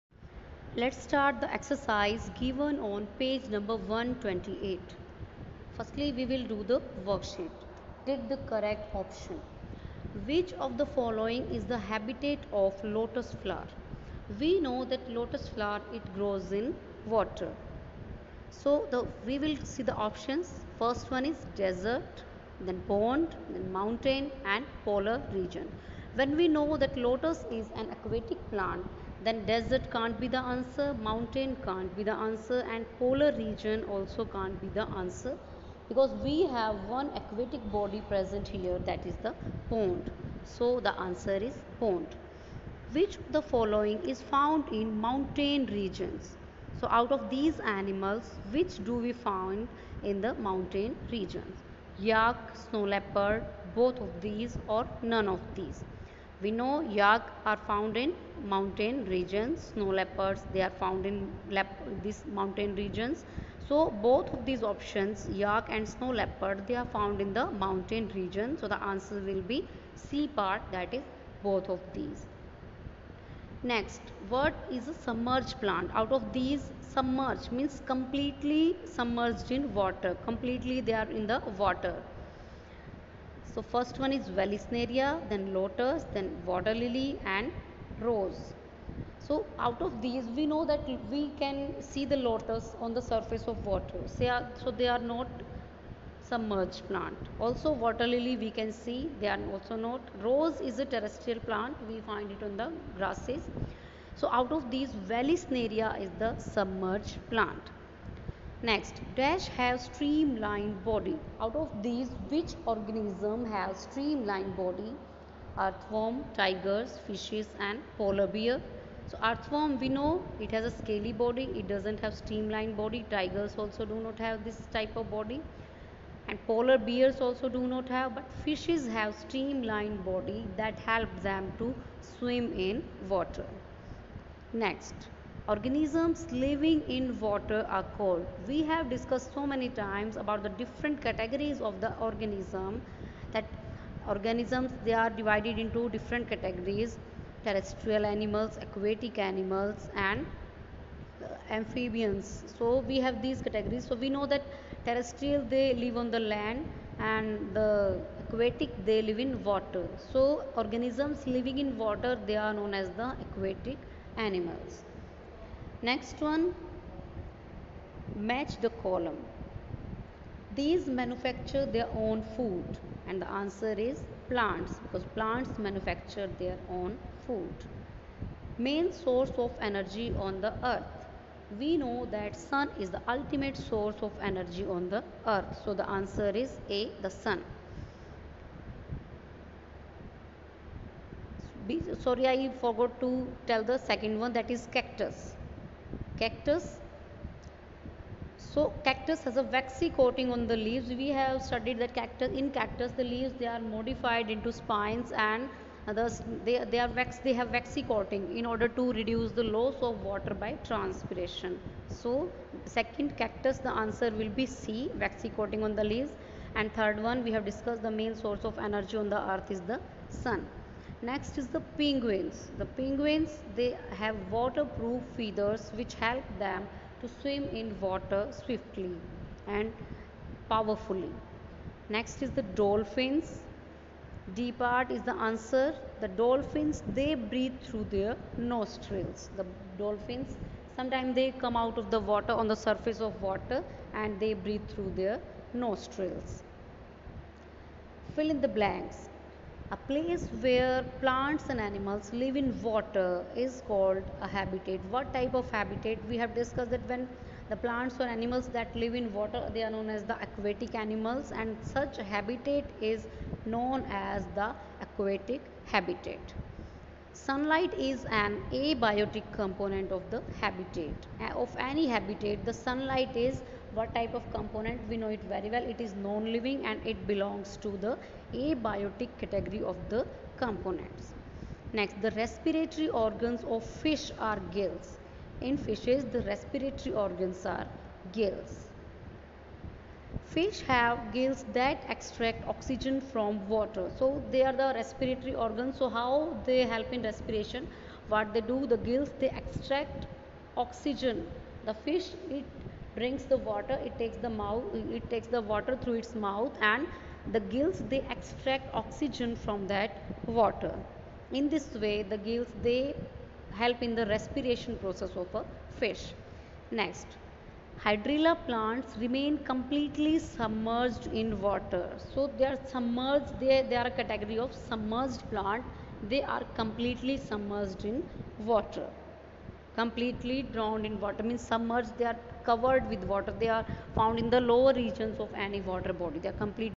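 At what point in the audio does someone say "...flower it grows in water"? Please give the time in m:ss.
0:15.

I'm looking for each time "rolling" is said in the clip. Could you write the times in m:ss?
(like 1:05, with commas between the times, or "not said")
not said.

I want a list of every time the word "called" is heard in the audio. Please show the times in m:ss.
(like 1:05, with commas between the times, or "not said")
2:17, 4:13.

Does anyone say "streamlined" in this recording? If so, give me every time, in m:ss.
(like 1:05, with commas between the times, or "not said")
1:49, 1:53, 2:02, 2:09.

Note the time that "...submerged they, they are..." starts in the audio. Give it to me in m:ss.
5:22.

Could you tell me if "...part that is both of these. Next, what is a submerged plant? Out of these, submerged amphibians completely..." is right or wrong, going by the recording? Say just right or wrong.
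wrong.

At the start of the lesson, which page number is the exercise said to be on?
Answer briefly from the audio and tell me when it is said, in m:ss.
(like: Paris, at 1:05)
128, at 0:03.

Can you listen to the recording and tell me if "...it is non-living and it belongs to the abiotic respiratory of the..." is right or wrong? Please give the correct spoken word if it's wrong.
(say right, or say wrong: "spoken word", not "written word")
wrong: "category", not "respiratory".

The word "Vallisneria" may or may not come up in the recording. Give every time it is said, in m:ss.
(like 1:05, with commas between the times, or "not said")
1:24, 1:45.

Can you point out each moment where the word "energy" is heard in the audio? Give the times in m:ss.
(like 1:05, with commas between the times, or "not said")
2:59, 3:04, 3:38.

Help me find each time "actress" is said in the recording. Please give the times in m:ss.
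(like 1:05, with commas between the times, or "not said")
not said.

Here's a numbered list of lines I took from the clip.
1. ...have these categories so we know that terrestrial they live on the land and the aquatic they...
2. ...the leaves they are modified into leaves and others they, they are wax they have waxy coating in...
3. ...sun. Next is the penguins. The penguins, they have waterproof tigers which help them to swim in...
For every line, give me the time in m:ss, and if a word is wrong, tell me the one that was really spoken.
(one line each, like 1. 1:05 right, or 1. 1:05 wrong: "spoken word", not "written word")
1. 2:33 right
2. 3:22 wrong: "spines", not "leaves"
3. 3:40 wrong: "feathers", not "tigers".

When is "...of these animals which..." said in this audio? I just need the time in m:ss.
0:47.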